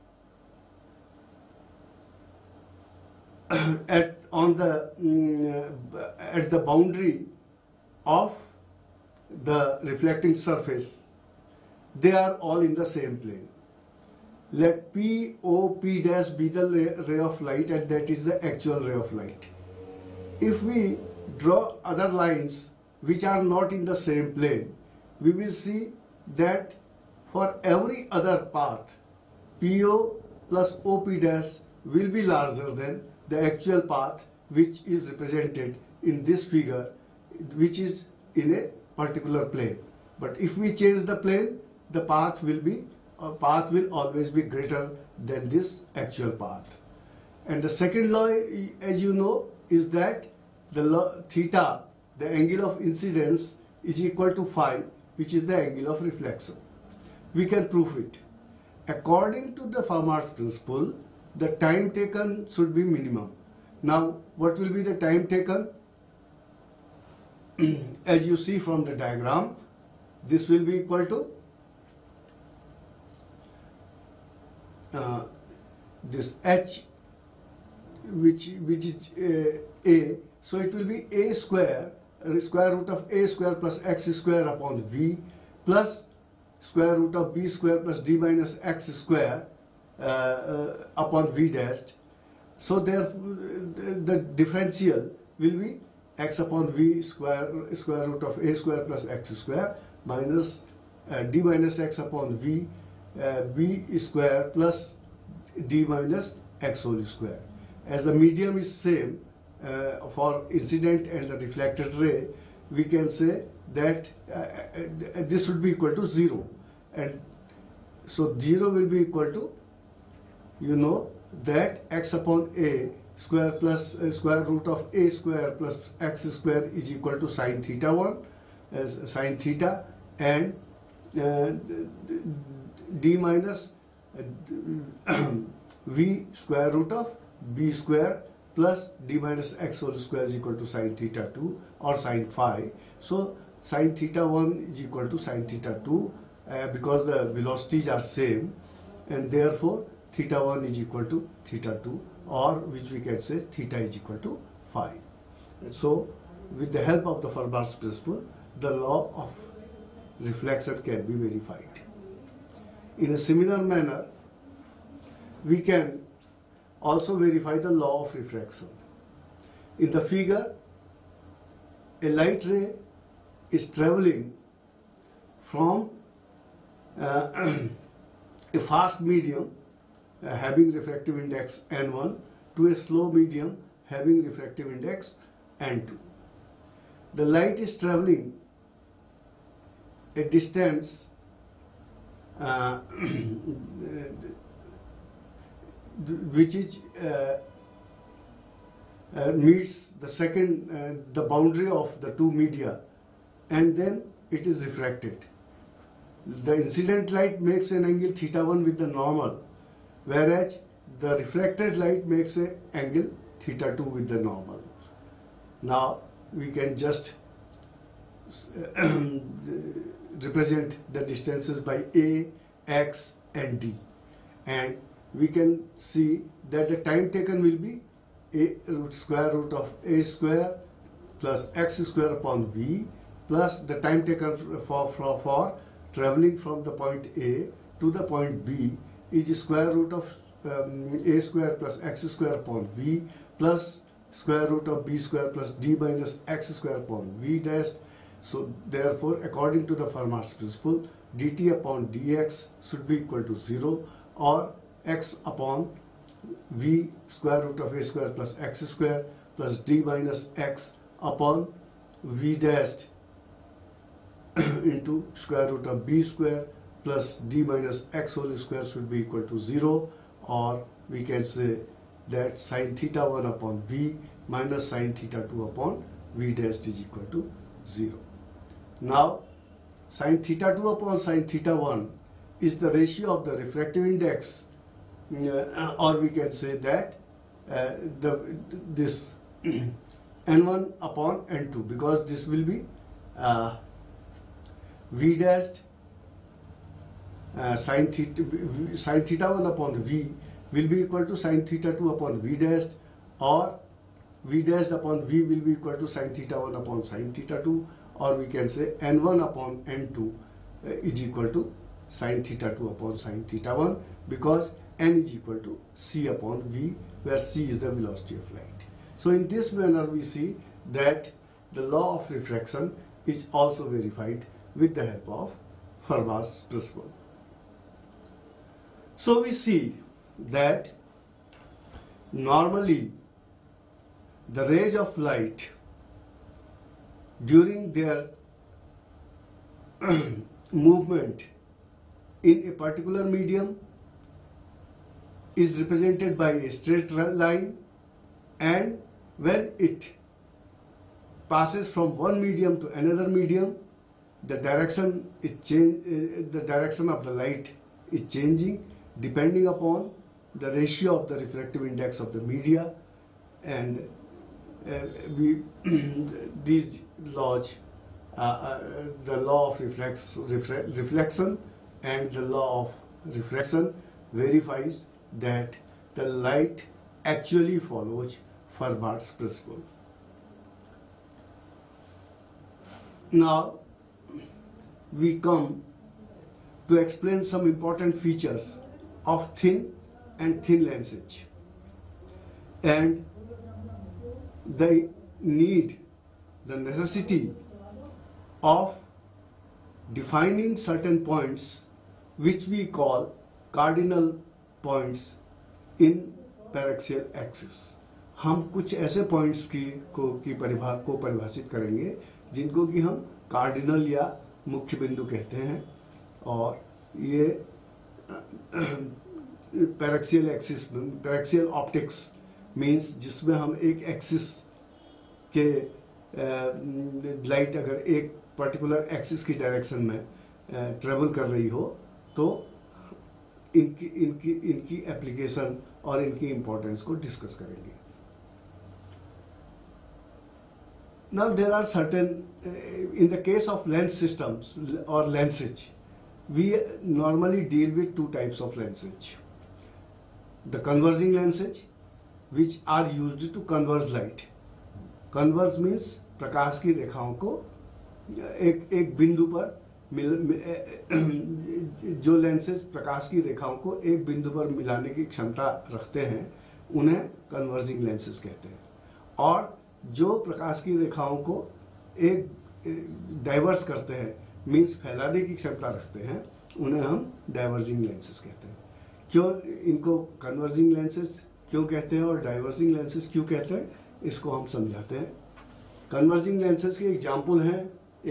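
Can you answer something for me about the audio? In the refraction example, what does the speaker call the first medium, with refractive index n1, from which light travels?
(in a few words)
a fast medium.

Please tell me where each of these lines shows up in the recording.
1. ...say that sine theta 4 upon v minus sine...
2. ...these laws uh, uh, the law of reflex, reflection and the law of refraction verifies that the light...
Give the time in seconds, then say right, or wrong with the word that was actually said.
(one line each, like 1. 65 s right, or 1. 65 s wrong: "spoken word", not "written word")
1. 271 s wrong: "1", not "4"
2. 366 s right.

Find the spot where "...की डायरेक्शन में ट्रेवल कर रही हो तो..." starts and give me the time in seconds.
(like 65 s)
429 s.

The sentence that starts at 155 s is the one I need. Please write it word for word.
So with the help of the Fermat's principle, the law of reflection can be verified.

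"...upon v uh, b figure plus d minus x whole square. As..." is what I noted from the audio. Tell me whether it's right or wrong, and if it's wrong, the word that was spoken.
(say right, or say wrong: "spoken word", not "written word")
wrong: "square", not "figure".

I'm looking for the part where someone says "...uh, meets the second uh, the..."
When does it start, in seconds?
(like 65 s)
199 s.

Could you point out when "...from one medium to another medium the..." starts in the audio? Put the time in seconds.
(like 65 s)
351 s.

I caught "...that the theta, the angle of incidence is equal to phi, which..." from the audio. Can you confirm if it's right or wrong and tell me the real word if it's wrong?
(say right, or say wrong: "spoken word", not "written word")
right.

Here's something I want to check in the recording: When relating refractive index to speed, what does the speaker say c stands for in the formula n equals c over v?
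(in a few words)
velocity of light.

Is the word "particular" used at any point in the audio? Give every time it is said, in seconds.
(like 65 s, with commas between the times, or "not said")
38 s, 342 s.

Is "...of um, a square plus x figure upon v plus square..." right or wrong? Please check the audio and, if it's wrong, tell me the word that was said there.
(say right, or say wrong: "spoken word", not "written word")
wrong: "square", not "figure".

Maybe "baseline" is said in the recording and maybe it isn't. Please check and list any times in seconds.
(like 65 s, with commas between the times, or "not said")
not said.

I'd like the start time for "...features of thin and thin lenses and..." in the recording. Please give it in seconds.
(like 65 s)
387 s.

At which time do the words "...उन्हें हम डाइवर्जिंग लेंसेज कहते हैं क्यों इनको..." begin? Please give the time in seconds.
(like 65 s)
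476 s.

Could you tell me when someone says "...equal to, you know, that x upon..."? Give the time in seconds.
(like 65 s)
118 s.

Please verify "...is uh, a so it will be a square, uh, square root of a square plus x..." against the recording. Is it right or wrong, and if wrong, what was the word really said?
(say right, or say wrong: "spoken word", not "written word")
right.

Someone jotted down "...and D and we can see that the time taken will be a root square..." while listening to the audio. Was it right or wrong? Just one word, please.
right.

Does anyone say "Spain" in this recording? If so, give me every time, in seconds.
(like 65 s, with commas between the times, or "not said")
not said.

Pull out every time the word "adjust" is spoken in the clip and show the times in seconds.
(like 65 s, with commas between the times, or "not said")
not said.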